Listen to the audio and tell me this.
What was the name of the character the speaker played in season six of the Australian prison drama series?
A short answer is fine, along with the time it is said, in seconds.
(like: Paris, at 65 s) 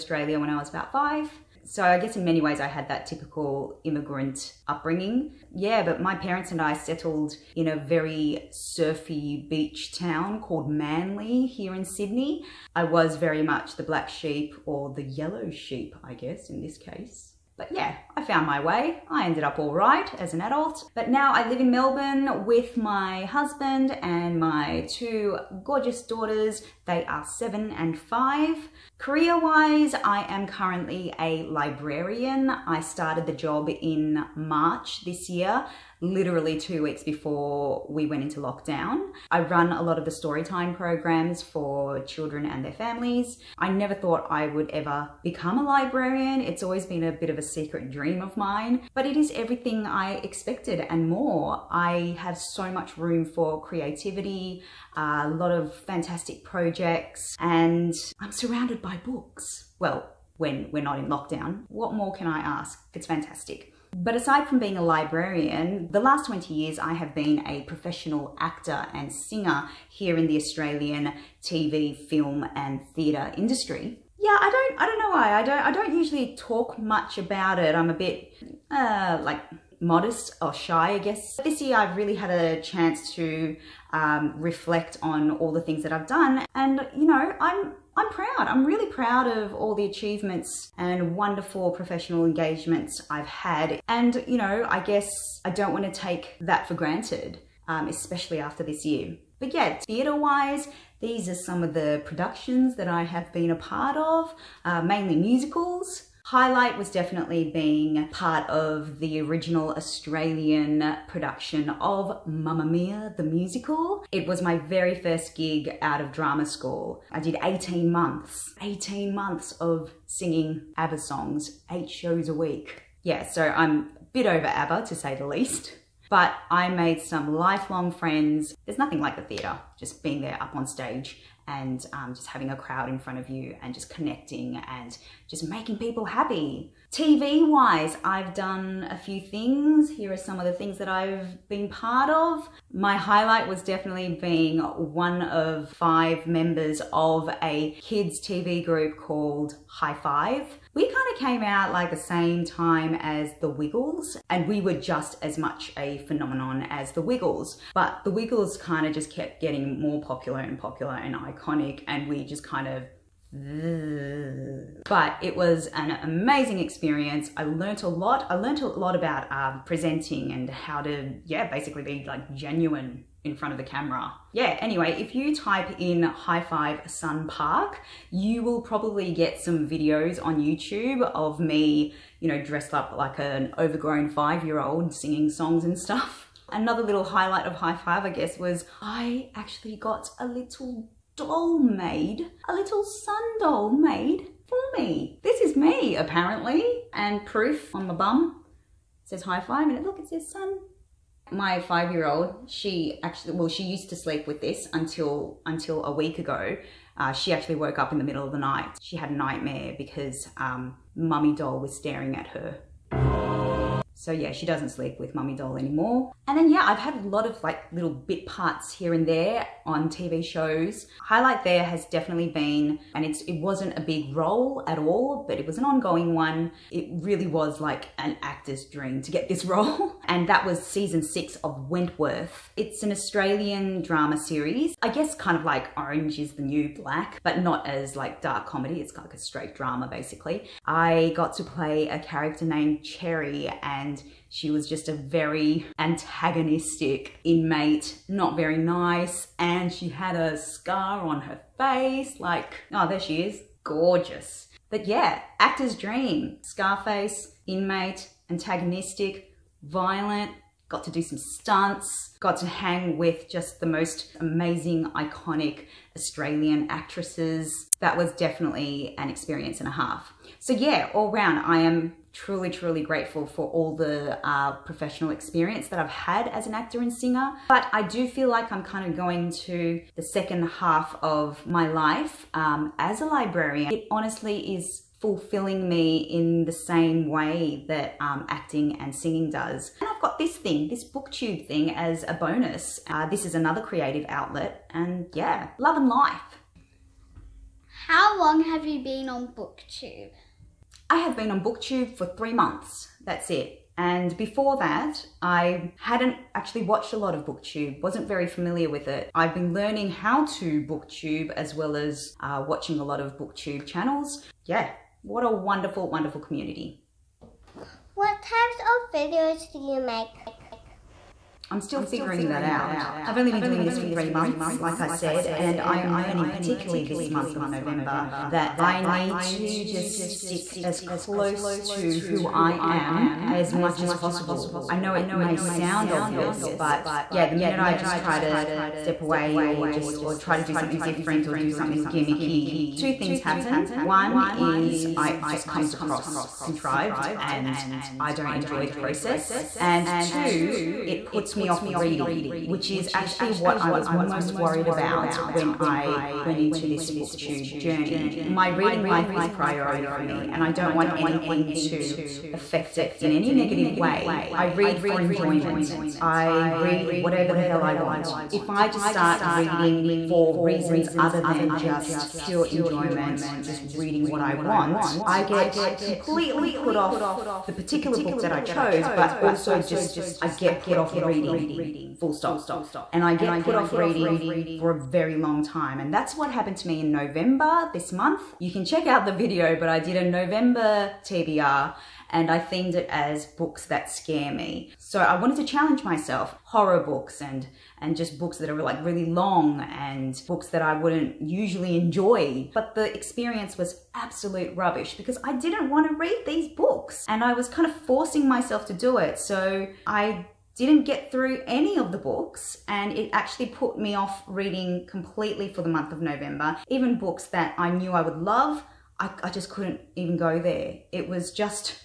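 Cherry, at 242 s.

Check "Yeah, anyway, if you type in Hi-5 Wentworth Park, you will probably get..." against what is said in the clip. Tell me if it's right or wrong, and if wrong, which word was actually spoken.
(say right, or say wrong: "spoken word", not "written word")
wrong: "Sun", not "Wentworth".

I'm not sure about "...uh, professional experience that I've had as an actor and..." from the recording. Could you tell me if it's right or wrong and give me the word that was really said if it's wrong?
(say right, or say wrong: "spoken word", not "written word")
right.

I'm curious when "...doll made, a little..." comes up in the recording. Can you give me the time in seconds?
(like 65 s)
191 s.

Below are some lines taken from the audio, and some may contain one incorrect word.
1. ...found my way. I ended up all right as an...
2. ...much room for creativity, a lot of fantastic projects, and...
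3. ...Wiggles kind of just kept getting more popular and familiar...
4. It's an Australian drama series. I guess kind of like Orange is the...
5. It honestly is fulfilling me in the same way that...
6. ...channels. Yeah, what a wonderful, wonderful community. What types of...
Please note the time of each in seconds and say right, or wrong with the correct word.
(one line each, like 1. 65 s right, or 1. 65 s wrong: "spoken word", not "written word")
1. 18 s right
2. 52 s right
3. 158 s wrong: "popular", not "familiar"
4. 232 s right
5. 283 s right
6. 313 s right.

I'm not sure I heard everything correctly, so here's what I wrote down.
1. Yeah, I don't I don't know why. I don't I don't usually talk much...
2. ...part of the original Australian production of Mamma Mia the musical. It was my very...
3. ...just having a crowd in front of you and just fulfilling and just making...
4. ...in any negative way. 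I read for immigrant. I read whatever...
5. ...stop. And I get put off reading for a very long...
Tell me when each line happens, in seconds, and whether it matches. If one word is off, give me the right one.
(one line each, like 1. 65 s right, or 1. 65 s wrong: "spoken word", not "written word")
1. 74 s right
2. 108 s right
3. 132 s wrong: "connecting", not "fulfilling"
4. 363 s wrong: "enjoyment", not "immigrant"
5. 382 s right.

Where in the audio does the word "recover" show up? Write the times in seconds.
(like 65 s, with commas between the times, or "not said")
not said.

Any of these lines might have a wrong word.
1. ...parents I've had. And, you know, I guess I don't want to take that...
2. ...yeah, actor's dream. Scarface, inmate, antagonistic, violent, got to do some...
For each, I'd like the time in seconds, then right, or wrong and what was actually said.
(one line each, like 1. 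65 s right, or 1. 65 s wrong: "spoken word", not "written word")
1. 92 s wrong: "engagements", not "parents"
2. 254 s right.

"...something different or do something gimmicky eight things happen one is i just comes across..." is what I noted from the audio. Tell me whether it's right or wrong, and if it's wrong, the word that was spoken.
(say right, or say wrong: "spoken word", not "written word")
wrong: "two", not "eight".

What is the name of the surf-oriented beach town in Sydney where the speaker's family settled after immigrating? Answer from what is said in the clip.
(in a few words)
Manly.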